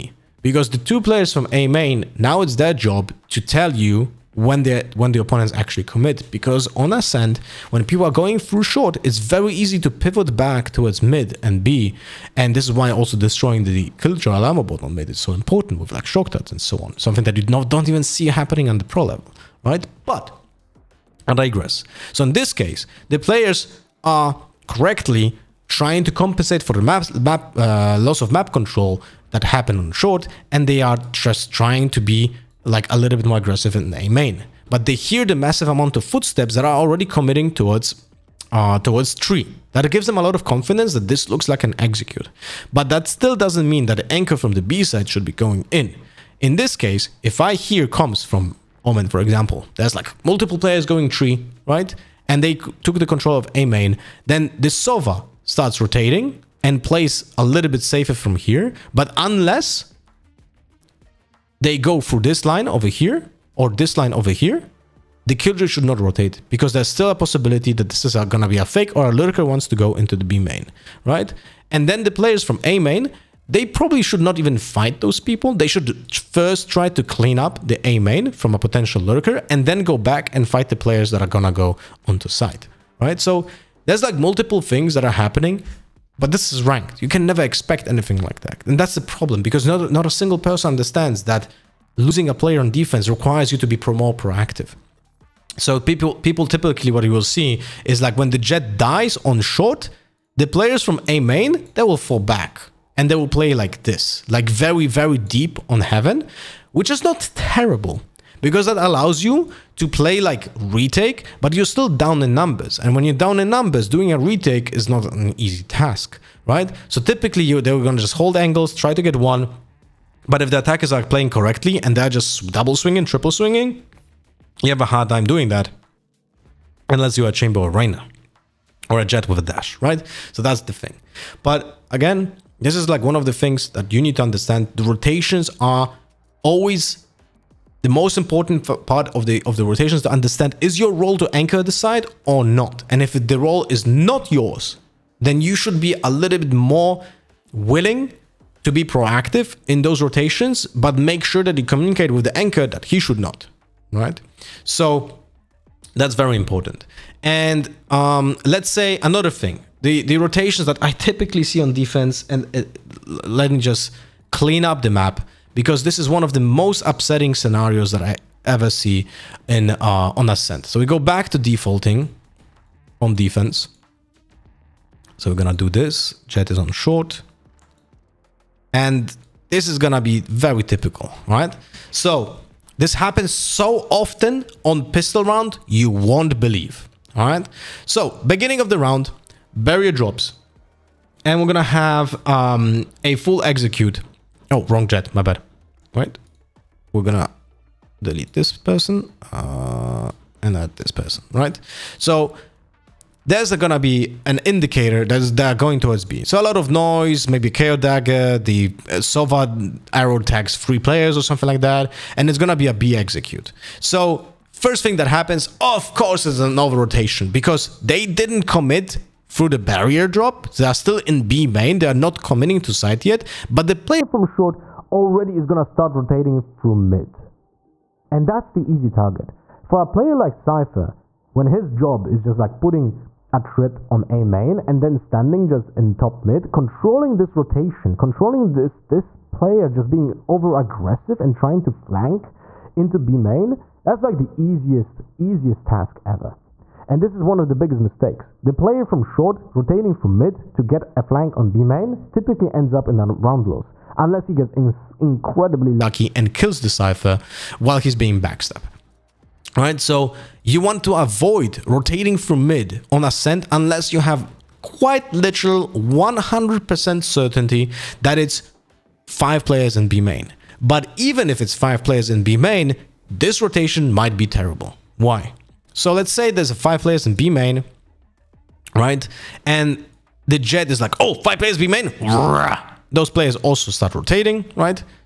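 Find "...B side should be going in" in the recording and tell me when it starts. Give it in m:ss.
0:44.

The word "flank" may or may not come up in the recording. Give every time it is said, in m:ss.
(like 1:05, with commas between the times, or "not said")
4:01, 4:11.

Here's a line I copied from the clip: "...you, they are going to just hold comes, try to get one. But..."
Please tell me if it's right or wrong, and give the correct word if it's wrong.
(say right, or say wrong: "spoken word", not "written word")
wrong: "angles", not "comes".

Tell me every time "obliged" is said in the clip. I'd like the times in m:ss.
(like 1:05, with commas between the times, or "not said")
not said.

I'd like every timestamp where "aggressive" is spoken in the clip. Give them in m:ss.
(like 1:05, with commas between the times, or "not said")
0:33, 4:00.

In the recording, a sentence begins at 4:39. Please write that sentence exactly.
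And the Jett is like, oh, five players B main.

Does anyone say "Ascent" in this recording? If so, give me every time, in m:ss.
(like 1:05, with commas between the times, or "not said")
0:06, 2:50, 4:23.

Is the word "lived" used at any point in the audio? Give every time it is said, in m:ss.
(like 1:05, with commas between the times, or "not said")
not said.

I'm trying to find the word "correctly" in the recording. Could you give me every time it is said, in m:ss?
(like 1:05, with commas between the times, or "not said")
0:24, 2:01.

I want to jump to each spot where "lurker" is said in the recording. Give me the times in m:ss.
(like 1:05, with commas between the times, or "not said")
1:09, 1:19.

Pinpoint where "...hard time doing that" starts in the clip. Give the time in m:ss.
2:04.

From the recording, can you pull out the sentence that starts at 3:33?
So first thing that happens, of course, is an over rotation because they didn't commit through the barrier drop.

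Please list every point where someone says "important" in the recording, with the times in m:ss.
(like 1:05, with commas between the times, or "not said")
0:15, 2:18, 2:36.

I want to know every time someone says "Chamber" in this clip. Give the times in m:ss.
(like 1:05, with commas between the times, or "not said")
2:07.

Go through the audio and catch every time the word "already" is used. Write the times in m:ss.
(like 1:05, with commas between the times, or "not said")
0:36, 3:44.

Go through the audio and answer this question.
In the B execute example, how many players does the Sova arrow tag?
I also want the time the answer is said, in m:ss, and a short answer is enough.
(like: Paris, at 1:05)
3, at 3:30.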